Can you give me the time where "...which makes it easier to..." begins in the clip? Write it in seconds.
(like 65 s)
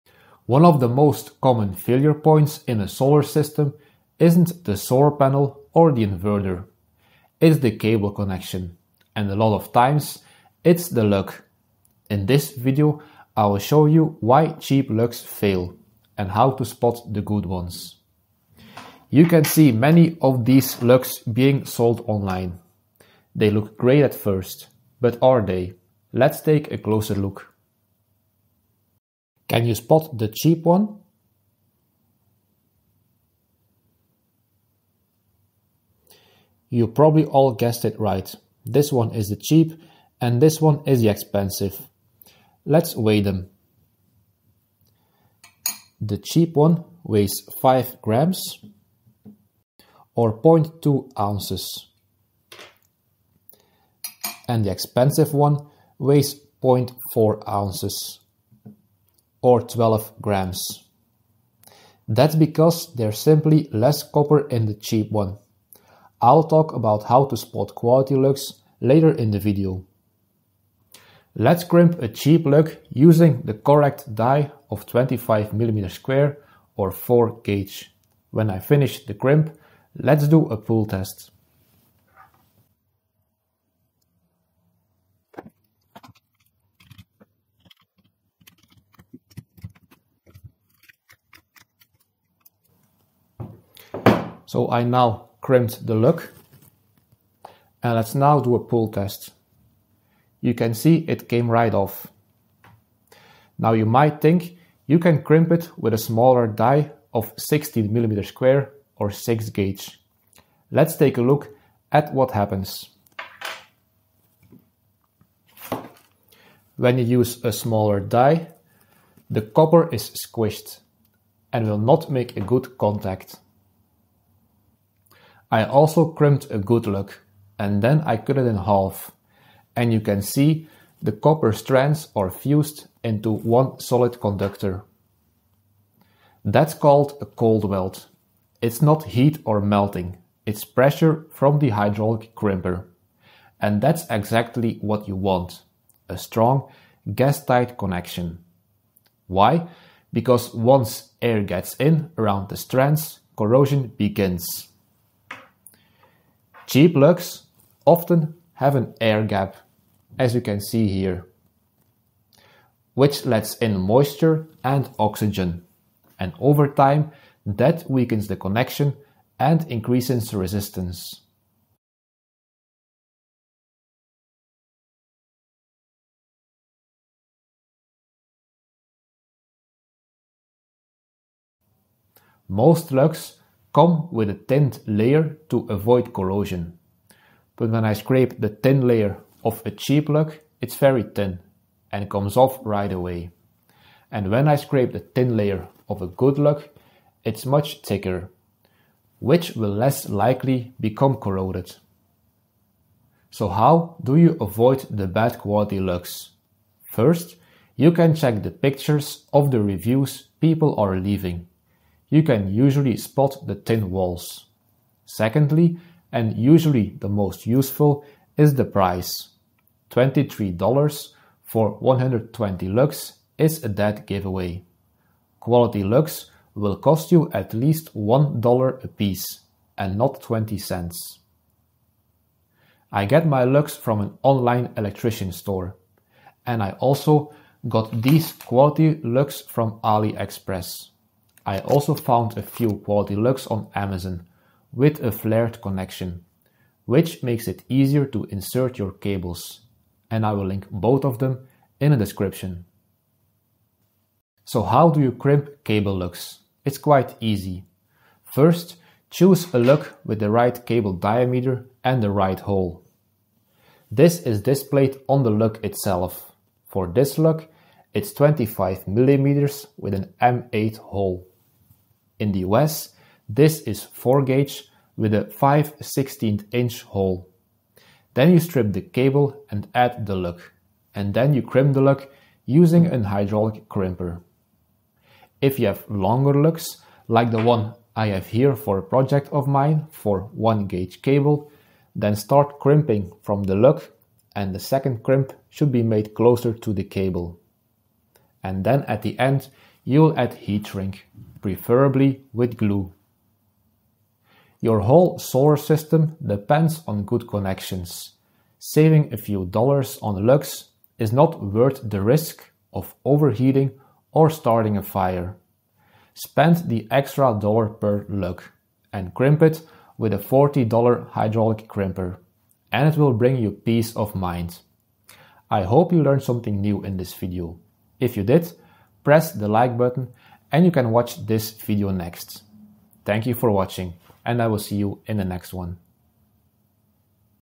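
246 s.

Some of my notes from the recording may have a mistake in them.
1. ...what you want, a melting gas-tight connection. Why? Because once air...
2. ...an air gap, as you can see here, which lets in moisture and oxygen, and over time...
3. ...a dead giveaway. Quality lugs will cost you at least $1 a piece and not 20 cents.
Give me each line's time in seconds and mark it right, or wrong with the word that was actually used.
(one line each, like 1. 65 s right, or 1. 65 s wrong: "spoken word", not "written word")
1. 144 s wrong: "strong", not "melting"
2. 158 s right
3. 223 s right.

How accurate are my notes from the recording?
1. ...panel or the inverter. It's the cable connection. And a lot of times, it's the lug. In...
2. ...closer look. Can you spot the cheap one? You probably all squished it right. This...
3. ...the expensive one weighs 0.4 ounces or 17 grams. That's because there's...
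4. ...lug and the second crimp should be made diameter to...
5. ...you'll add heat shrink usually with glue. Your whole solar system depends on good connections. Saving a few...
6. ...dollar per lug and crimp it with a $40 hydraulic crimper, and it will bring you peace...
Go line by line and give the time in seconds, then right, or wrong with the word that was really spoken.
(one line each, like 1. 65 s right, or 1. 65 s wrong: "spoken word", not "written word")
1. 5 s right
2. 26 s wrong: "guessed", not "squished"
3. 54 s wrong: "12", not "17"
4. 293 s wrong: "closer", not "diameter"
5. 299 s wrong: "preferably", not "usually"
6. 317 s right.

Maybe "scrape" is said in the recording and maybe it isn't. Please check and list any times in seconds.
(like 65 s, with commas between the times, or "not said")
187 s, 194 s.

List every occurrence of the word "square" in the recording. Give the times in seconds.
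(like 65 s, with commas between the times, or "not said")
75 s, 108 s.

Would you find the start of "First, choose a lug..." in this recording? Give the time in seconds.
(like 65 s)
258 s.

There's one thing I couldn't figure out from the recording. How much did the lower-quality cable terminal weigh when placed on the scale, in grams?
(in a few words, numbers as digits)
5 grams.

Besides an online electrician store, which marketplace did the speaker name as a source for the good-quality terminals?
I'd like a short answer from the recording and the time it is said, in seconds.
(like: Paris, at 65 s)
AliExpress, at 239 s.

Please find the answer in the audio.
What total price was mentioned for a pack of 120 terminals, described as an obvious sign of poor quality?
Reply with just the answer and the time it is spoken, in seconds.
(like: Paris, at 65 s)
$23, at 219 s.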